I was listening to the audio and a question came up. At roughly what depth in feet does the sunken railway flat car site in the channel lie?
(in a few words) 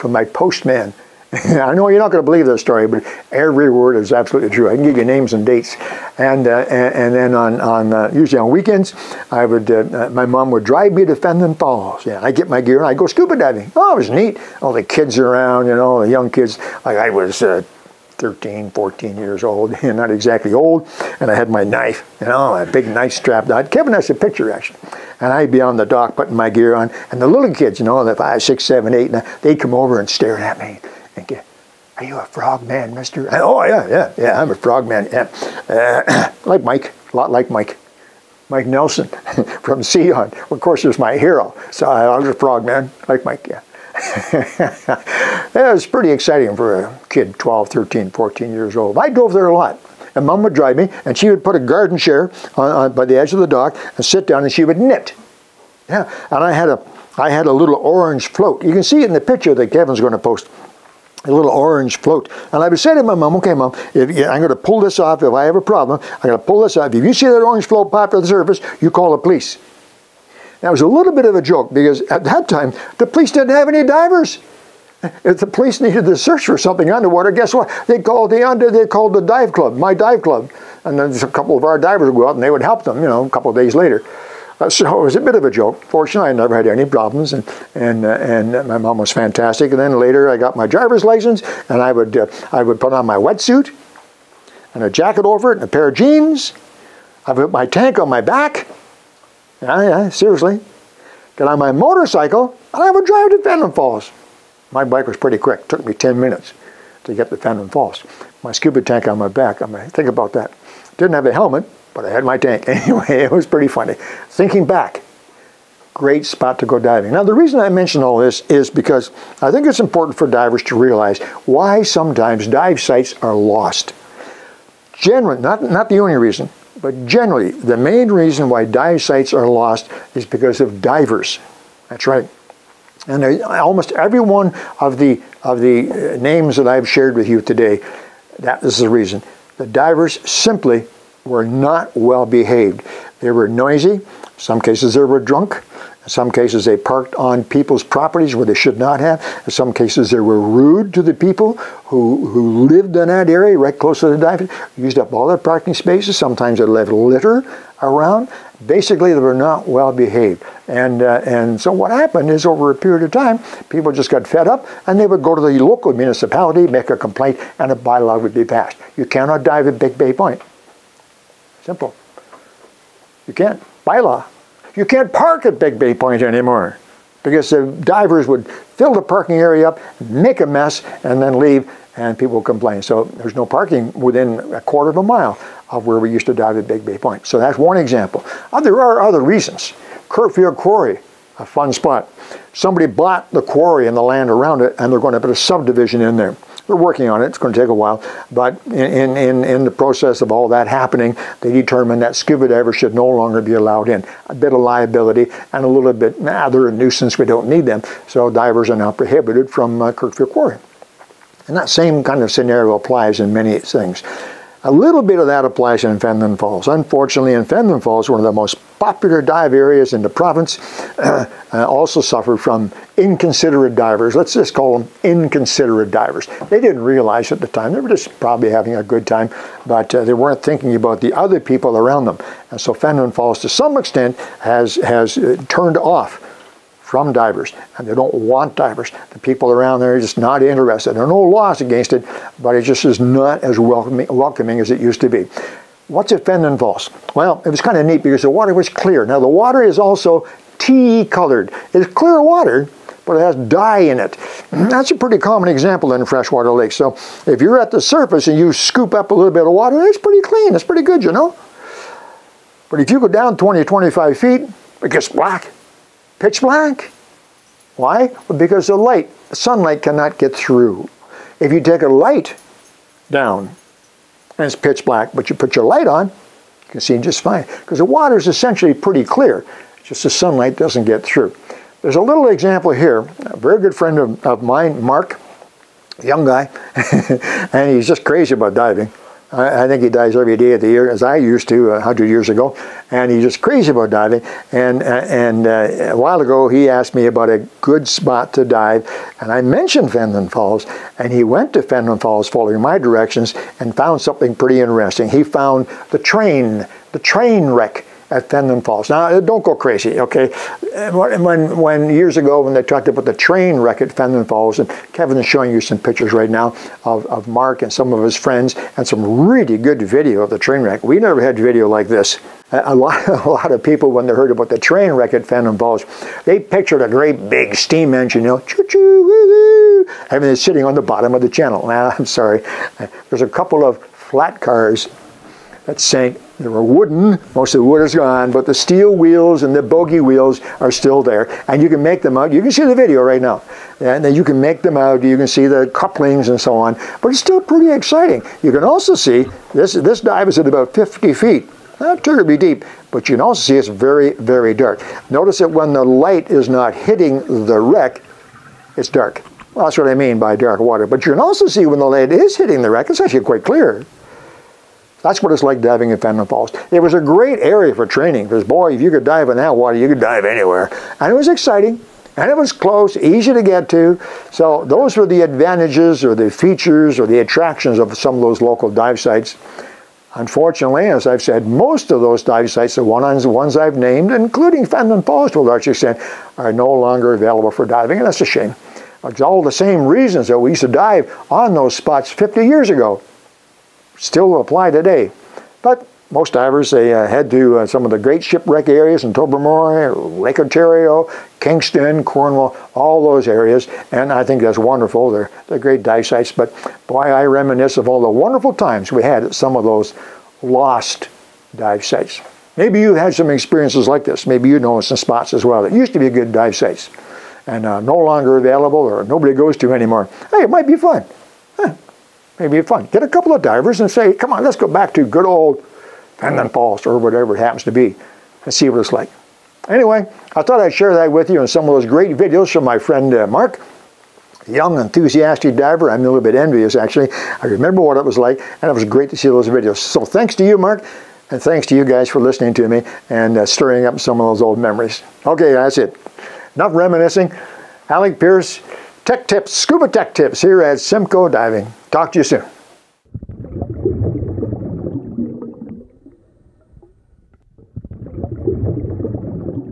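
50 feet.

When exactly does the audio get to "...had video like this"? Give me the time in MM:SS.
05:21.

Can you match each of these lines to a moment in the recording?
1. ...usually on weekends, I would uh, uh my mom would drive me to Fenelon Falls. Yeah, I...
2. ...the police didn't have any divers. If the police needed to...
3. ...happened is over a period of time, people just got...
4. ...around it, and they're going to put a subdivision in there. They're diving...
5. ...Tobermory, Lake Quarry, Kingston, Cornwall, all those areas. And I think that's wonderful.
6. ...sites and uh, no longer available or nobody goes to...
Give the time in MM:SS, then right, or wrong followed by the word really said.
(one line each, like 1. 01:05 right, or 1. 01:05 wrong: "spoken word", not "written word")
1. 00:08 right
2. 01:12 right
3. 02:41 right
4. 03:14 wrong: "working", not "diving"
5. 06:39 wrong: "Ontario", not "Quarry"
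6. 06:56 right.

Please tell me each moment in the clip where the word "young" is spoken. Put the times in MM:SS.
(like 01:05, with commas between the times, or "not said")
00:16, 04:46, 07:14.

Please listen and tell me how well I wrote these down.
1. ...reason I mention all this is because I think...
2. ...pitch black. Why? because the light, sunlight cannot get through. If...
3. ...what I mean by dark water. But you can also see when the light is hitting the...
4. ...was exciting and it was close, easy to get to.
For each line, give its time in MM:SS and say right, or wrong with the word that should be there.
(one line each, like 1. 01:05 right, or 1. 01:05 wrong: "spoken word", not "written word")
1. 01:57 right
2. 04:26 right
3. 05:59 right
4. 06:11 right.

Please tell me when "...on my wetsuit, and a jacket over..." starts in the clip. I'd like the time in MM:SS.
01:32.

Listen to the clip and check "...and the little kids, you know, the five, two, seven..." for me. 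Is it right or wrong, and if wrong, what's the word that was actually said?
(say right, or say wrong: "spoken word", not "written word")
wrong: "six", not "two".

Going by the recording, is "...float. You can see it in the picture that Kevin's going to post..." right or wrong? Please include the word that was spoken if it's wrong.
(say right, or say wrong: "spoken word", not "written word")
right.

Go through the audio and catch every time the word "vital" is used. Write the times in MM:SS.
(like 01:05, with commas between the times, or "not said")
not said.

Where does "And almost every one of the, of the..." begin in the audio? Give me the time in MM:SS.
02:13.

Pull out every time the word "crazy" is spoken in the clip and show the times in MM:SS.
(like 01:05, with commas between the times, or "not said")
04:48, 04:53, 05:09.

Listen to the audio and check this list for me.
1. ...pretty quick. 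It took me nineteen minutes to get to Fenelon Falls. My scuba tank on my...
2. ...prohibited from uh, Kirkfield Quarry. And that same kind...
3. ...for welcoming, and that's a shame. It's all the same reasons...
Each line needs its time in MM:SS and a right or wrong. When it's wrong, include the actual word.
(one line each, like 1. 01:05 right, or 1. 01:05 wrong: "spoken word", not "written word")
1. 01:45 wrong: "ten", not "nineteen"
2. 03:28 right
3. 06:27 wrong: "diving", not "welcoming".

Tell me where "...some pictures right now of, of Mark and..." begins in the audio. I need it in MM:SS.
05:15.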